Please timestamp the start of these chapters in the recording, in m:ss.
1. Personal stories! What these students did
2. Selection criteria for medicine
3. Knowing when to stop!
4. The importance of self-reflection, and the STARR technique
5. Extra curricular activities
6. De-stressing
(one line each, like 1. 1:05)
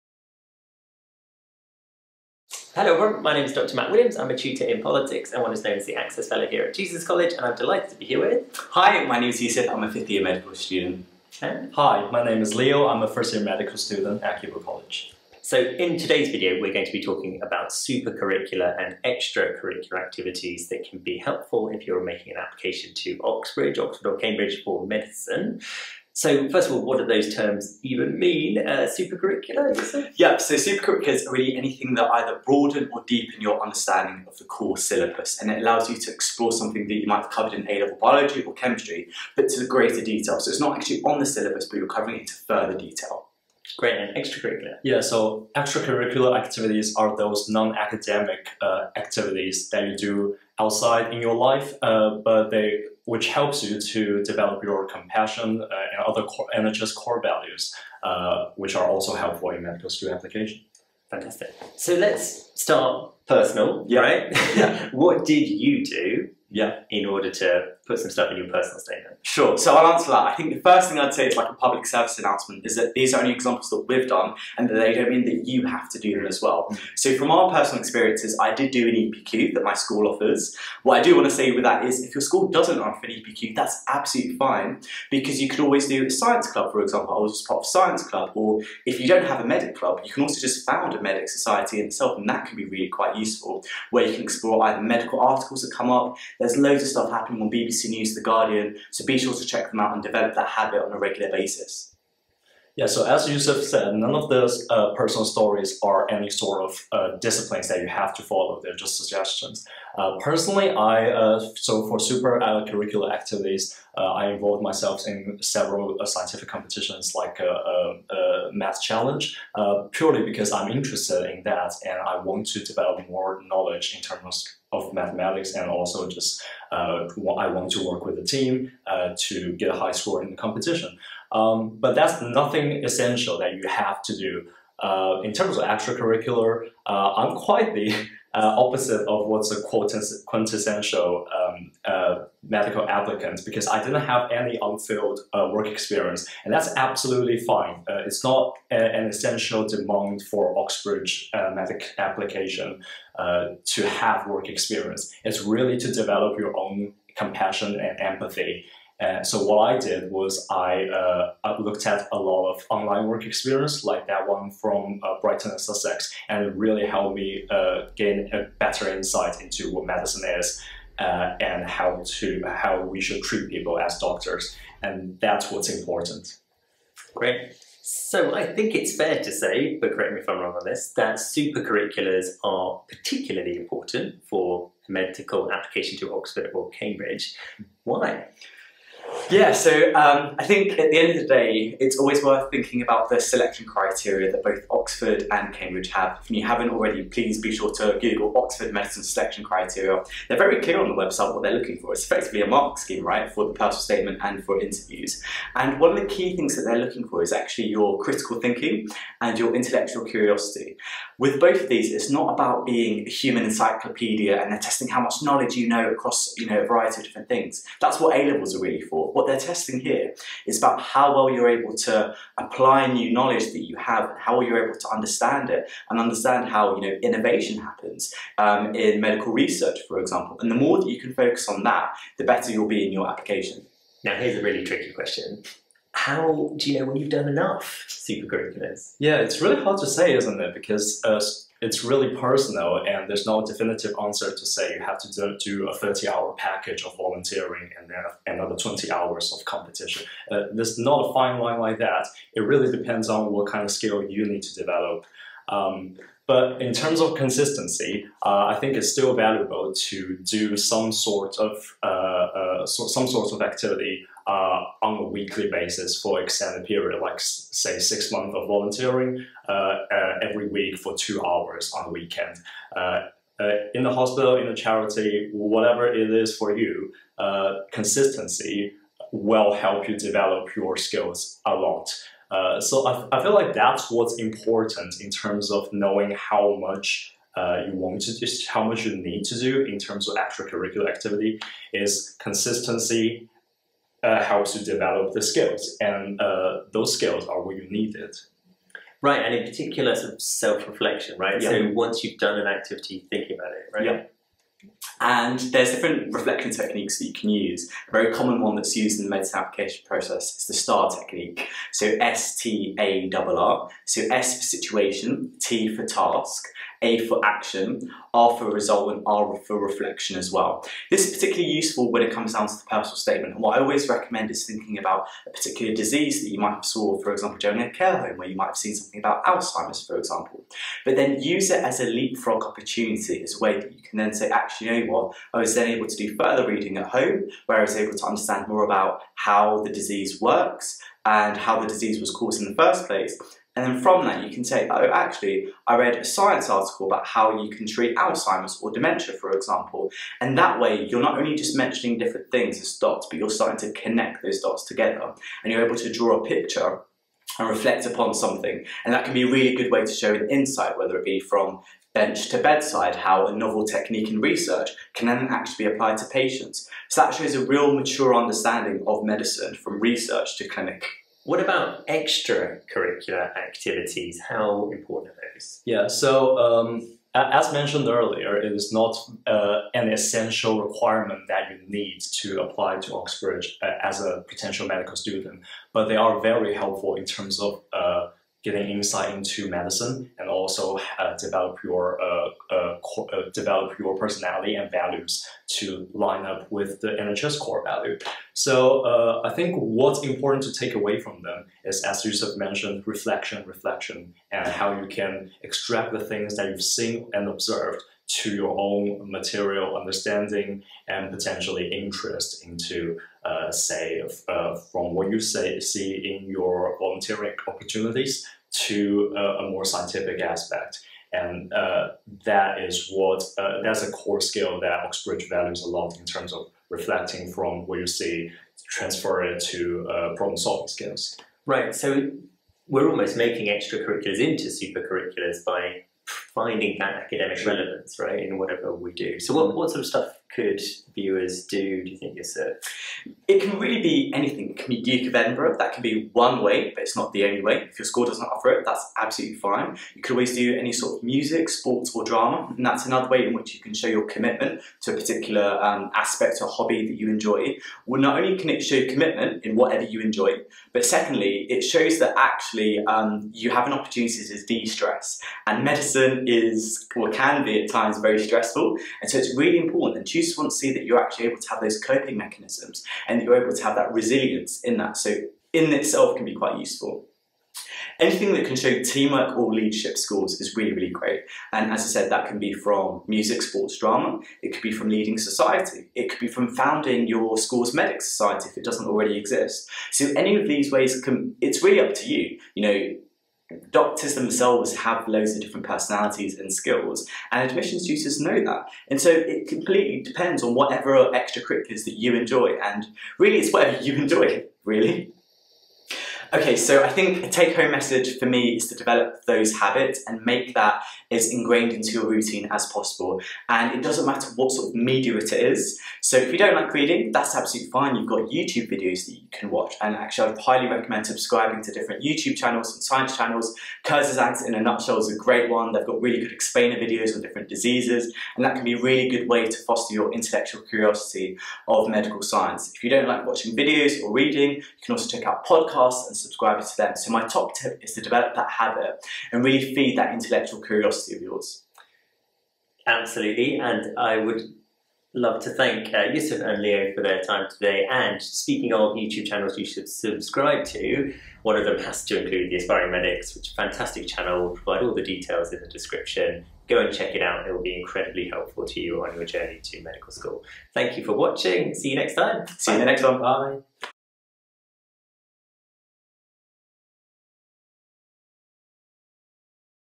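1. 1:02
2. 2:58
3. 3:54
4. 5:06
5. 6:11
6. 7:45.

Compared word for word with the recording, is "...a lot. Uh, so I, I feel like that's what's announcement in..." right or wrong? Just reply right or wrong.
wrong.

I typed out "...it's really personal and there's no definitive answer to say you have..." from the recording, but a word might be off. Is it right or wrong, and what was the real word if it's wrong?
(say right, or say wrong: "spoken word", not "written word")
right.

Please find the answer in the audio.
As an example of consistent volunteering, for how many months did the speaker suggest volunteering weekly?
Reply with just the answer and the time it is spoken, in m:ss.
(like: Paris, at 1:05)
6, at 4:27.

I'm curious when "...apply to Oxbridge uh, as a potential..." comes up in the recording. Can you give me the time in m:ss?
6:22.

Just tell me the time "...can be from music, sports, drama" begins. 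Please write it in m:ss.
8:02.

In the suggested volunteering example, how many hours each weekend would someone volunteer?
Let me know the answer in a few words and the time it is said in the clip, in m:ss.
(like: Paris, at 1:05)
2, at 4:30.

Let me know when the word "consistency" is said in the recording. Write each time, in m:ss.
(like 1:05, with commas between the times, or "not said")
4:17, 4:37, 4:52.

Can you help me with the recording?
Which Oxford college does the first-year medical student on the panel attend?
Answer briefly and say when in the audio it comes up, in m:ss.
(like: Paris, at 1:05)
Keble College, at 0:14.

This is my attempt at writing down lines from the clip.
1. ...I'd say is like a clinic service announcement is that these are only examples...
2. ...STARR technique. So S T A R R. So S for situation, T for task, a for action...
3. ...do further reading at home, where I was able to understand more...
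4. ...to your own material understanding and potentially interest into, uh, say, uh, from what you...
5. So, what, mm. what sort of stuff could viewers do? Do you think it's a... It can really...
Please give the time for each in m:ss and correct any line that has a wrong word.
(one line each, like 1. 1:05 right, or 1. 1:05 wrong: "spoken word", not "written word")
1. 1:10 wrong: "public", not "clinic"
2. 5:10 right
3. 5:35 right
4. 6:48 right
5. 7:19 right.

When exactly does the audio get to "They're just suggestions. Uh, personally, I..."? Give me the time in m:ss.
1:48.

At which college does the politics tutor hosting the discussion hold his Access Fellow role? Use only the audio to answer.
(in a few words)
Jesus College.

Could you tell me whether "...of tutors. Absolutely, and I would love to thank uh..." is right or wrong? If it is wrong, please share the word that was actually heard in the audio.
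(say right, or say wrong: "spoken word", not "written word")
wrong: "yours", not "tutors".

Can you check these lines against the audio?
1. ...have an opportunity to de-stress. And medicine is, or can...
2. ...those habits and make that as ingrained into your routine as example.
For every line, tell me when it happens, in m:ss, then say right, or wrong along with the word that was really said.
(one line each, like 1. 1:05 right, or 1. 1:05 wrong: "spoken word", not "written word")
1. 7:43 right
2. 8:29 wrong: "possible", not "example".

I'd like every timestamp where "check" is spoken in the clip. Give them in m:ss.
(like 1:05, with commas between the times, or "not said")
1:39, 8:55, 9:16.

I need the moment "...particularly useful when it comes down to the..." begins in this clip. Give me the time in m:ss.
5:21.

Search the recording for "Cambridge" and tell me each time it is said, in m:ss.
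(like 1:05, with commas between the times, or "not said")
0:24, 3:06, 3:15.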